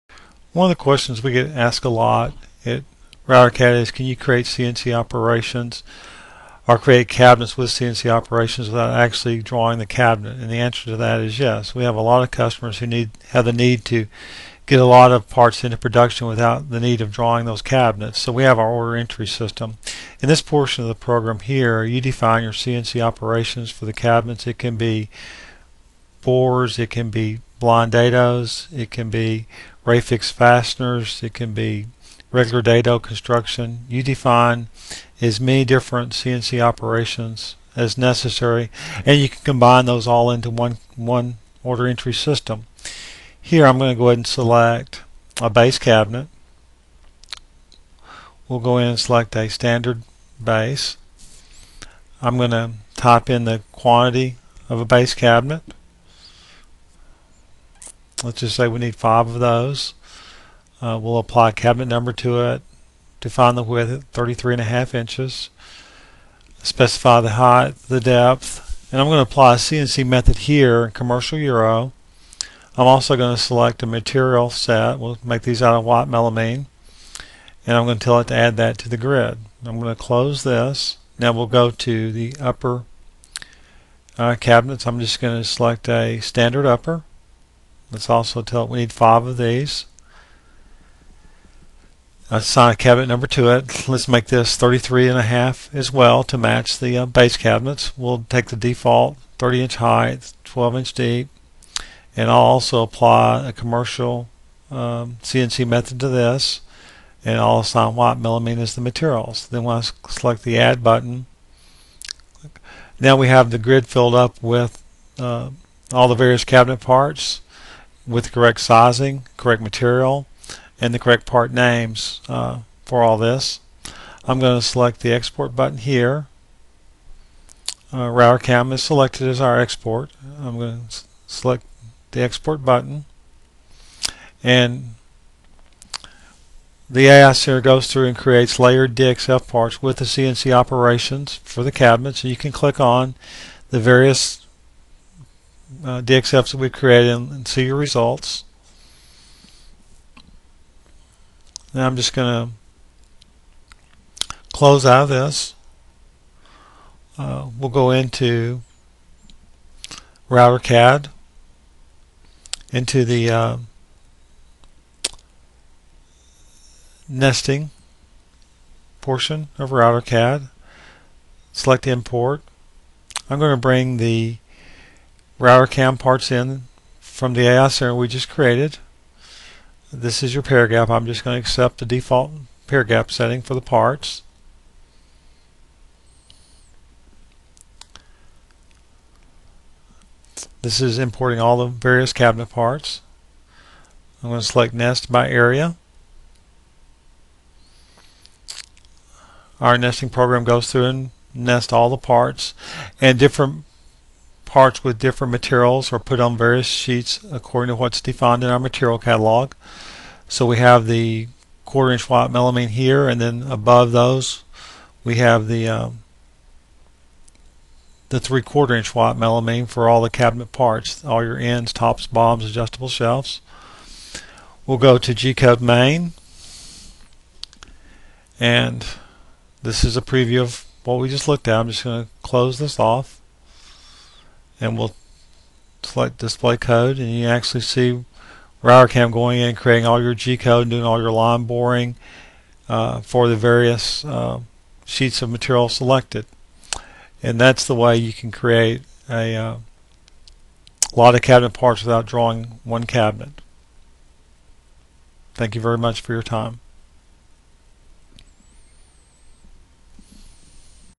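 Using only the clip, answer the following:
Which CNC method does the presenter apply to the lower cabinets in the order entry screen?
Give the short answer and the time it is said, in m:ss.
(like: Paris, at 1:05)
commercial euro, at 1:10.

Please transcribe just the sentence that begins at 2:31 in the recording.
Now I'm just going to close out of this.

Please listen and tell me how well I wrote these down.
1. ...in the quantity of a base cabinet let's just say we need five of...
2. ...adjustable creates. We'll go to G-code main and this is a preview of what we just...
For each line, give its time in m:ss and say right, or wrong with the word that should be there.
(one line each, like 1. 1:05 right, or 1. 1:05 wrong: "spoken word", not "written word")
1. 0:53 right
2. 3:42 wrong: "shelves", not "creates".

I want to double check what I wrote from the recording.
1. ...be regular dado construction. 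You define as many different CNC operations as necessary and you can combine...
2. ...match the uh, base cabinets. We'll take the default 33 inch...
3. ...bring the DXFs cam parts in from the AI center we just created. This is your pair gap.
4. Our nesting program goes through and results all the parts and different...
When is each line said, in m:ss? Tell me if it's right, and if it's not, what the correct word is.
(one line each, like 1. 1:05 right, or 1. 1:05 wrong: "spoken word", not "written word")
1. 0:31 right
2. 1:36 wrong: "30", not "33"
3. 2:53 wrong: "Router", not "DXFs"
4. 3:19 wrong: "nests", not "results".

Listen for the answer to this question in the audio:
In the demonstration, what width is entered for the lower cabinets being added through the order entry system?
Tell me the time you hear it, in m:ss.
1:04.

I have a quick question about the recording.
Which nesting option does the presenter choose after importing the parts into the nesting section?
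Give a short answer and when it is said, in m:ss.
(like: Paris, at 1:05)
nest by area, at 3:14.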